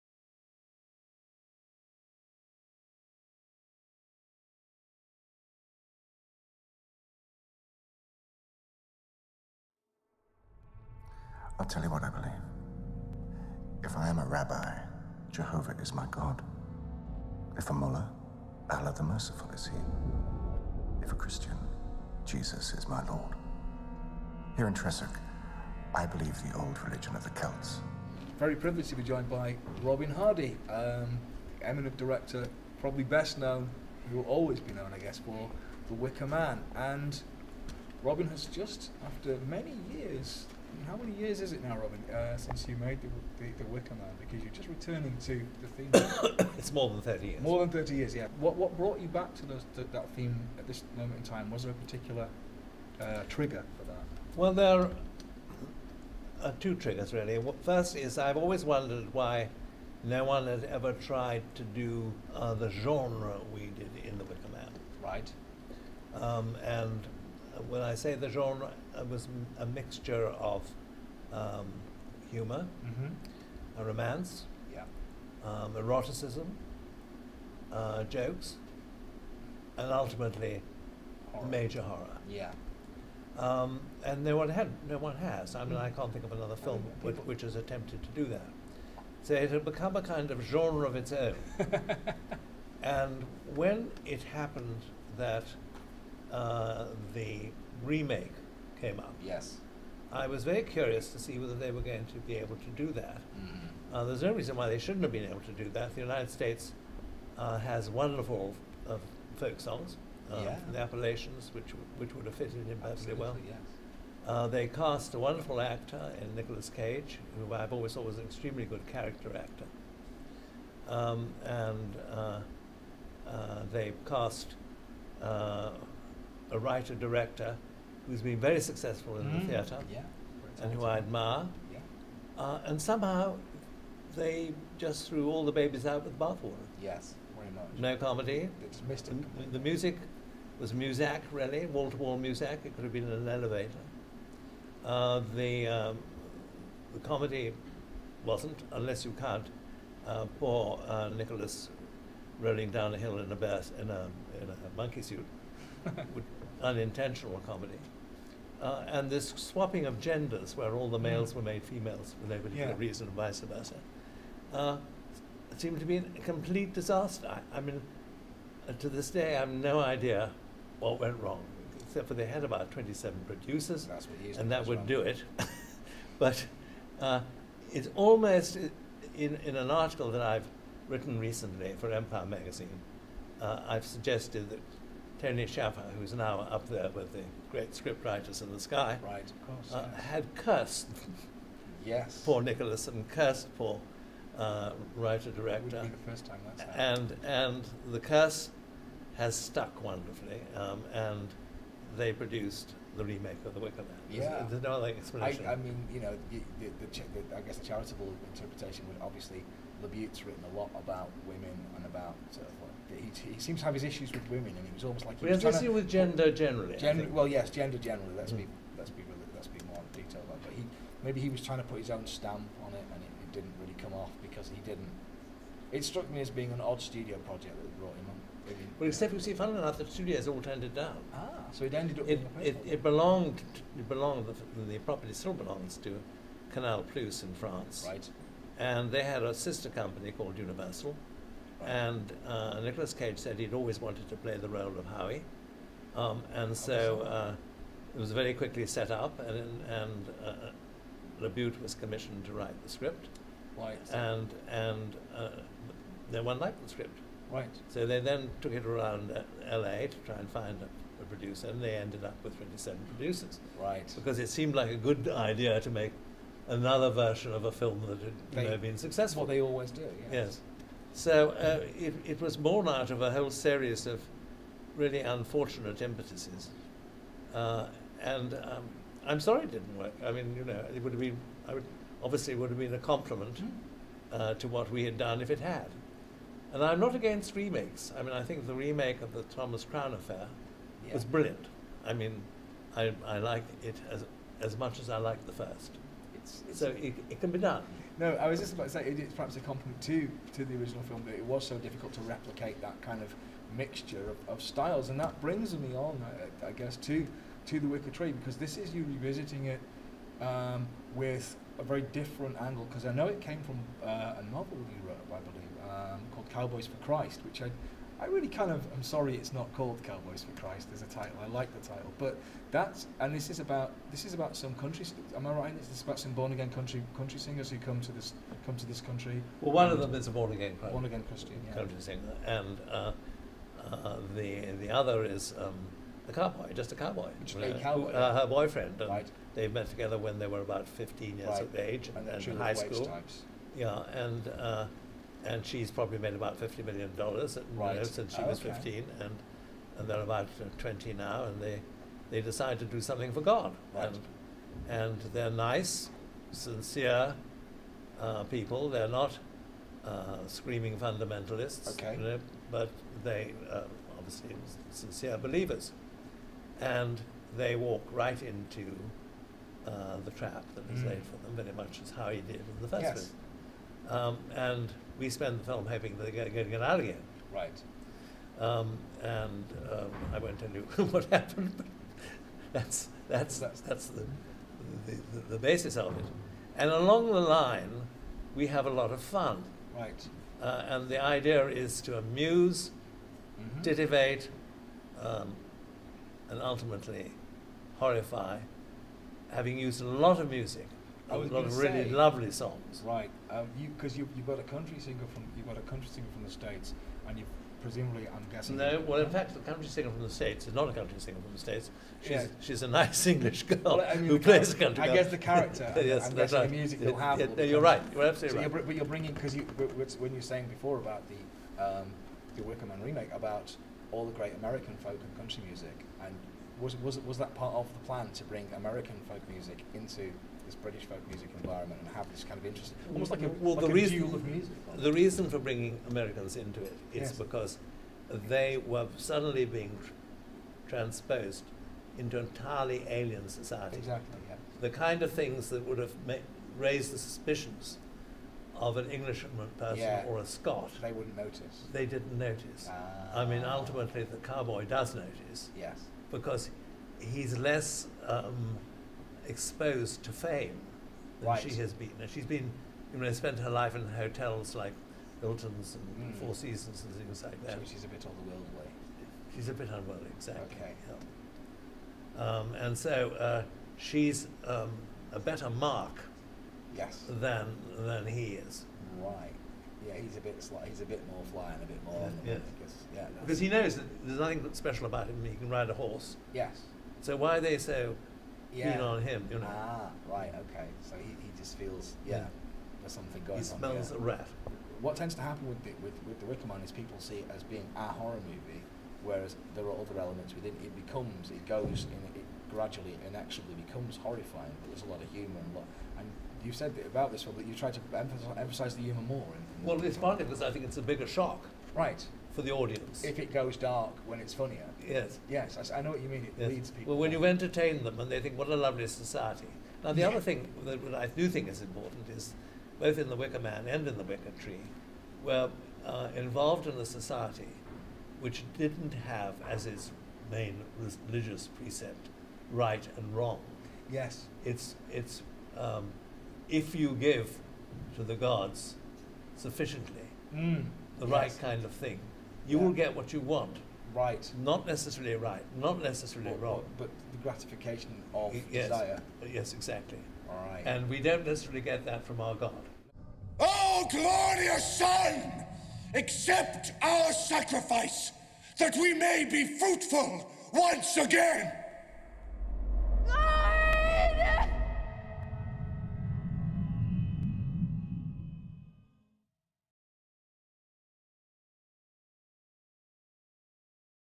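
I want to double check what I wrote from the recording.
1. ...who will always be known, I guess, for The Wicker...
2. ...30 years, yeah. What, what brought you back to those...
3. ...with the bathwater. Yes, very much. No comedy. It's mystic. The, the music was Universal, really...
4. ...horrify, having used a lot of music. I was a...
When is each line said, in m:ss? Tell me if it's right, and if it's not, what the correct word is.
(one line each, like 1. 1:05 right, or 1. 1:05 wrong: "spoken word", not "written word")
1. 0:34 right
2. 0:47 right
3. 2:16 wrong: "Muzak", not "Universal"
4. 6:37 right.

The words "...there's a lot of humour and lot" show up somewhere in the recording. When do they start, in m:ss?
8:24.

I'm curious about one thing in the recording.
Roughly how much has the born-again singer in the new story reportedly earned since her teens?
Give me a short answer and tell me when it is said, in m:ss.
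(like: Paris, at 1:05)
$50 million, at 5:46.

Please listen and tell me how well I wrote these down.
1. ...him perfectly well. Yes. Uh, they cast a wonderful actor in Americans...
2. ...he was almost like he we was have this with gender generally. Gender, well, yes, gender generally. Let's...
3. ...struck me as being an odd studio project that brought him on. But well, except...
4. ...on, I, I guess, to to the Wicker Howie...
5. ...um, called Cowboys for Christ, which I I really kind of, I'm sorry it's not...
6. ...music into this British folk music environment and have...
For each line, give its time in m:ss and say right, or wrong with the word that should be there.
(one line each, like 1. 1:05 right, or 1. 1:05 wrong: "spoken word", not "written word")
1. 1:52 wrong: "Nicolas", not "Americans"
2. 3:34 right
3. 3:45 right
4. 5:05 wrong: "Tree", not "Howie"
5. 5:15 right
6. 7:09 right.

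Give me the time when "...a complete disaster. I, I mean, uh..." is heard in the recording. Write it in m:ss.
2:45.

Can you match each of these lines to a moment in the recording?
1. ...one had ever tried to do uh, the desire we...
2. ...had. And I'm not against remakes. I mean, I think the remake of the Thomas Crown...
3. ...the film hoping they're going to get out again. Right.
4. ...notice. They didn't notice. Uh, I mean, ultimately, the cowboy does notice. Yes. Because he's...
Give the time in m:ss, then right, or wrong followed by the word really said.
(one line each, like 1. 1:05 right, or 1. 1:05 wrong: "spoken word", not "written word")
1. 1:00 wrong: "genre", not "desire"
2. 4:45 right
3. 6:15 right
4. 7:31 right.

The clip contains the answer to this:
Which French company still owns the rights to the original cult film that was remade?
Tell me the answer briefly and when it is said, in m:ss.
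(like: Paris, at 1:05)
Canal Plus, at 3:56.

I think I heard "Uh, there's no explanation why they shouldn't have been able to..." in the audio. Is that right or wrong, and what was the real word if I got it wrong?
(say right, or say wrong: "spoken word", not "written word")
wrong: "reason", not "explanation".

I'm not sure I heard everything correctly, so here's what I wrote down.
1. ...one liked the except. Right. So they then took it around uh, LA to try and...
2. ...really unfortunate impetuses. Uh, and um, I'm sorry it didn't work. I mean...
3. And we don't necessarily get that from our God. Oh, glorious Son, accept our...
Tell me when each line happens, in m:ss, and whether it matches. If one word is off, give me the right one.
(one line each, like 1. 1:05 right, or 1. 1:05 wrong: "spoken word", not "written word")
1. 4:16 wrong: "script", not "except"
2. 4:34 right
3. 9:10 right.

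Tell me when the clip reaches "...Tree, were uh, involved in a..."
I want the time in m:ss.
8:44.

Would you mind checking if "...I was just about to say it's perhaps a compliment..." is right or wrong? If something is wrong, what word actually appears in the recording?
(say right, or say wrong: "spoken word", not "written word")
right.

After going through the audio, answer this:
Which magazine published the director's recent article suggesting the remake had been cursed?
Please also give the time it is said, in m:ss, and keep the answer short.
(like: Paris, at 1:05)
Empire, at 3:01.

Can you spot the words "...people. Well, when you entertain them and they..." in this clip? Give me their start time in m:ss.
8:36.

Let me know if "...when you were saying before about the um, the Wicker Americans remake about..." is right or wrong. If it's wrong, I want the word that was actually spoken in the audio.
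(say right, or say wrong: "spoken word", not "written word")
wrong: "Man", not "Americans".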